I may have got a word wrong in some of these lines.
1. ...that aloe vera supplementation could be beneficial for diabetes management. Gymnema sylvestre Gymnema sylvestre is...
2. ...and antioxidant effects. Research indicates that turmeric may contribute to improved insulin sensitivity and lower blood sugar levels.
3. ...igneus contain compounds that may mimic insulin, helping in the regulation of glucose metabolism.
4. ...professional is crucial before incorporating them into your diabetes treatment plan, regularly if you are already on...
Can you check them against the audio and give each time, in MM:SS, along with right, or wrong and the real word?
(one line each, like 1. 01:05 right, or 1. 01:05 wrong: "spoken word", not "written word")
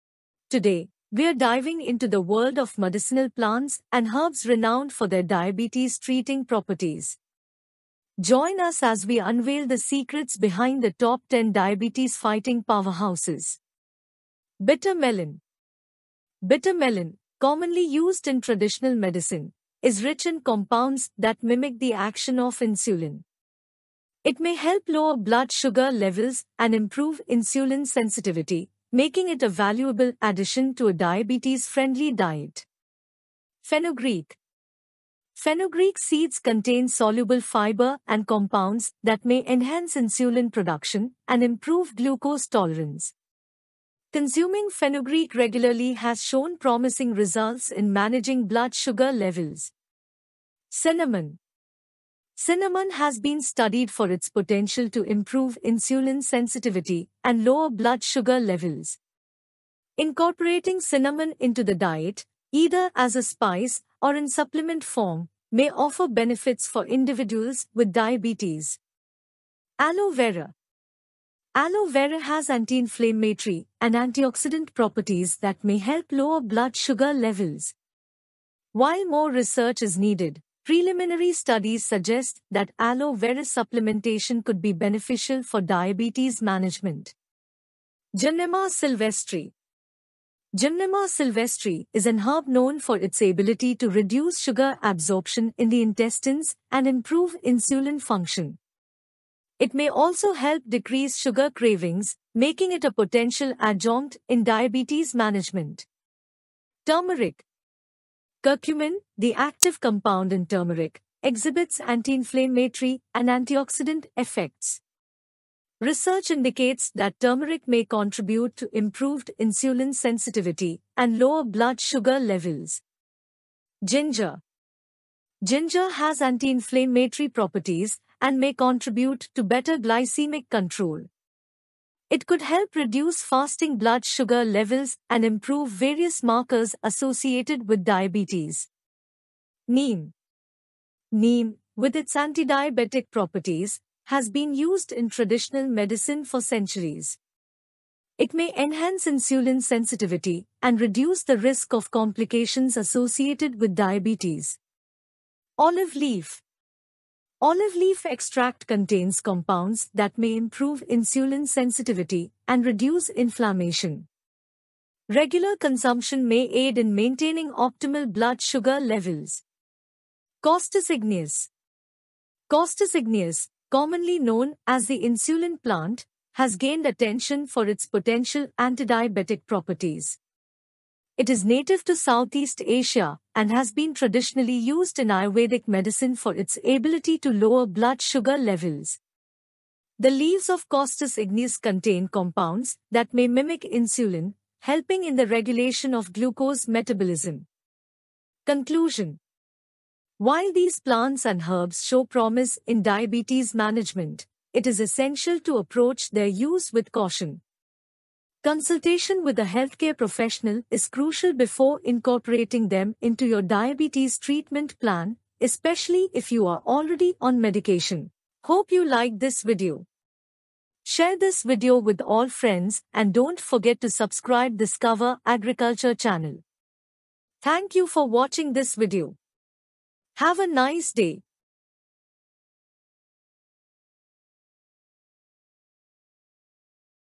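1. 01:22 right
2. 01:53 right
3. 03:11 right
4. 03:29 wrong: "especially", not "regularly".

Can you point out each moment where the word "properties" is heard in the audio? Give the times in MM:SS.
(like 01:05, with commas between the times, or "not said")
00:06, 01:14, 02:07, 02:23, 02:59.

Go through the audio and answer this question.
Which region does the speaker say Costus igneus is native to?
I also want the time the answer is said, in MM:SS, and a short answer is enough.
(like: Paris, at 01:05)
Southeast Asia, at 03:01.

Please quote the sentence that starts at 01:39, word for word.
It may also help decrease sugar cravings, making it a potential adjunct in diabetes management.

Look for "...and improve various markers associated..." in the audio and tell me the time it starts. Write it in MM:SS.
02:15.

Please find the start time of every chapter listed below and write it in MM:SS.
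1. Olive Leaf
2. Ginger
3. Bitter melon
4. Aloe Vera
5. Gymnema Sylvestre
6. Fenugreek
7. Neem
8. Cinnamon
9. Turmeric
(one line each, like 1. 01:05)
1. 02:35
2. 02:03
3. 00:14
4. 01:09
5. 01:27
6. 00:33
7. 02:19
8. 00:50
9. 01:46.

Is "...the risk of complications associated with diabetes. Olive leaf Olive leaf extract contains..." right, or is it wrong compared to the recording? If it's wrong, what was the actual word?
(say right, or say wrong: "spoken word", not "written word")
right.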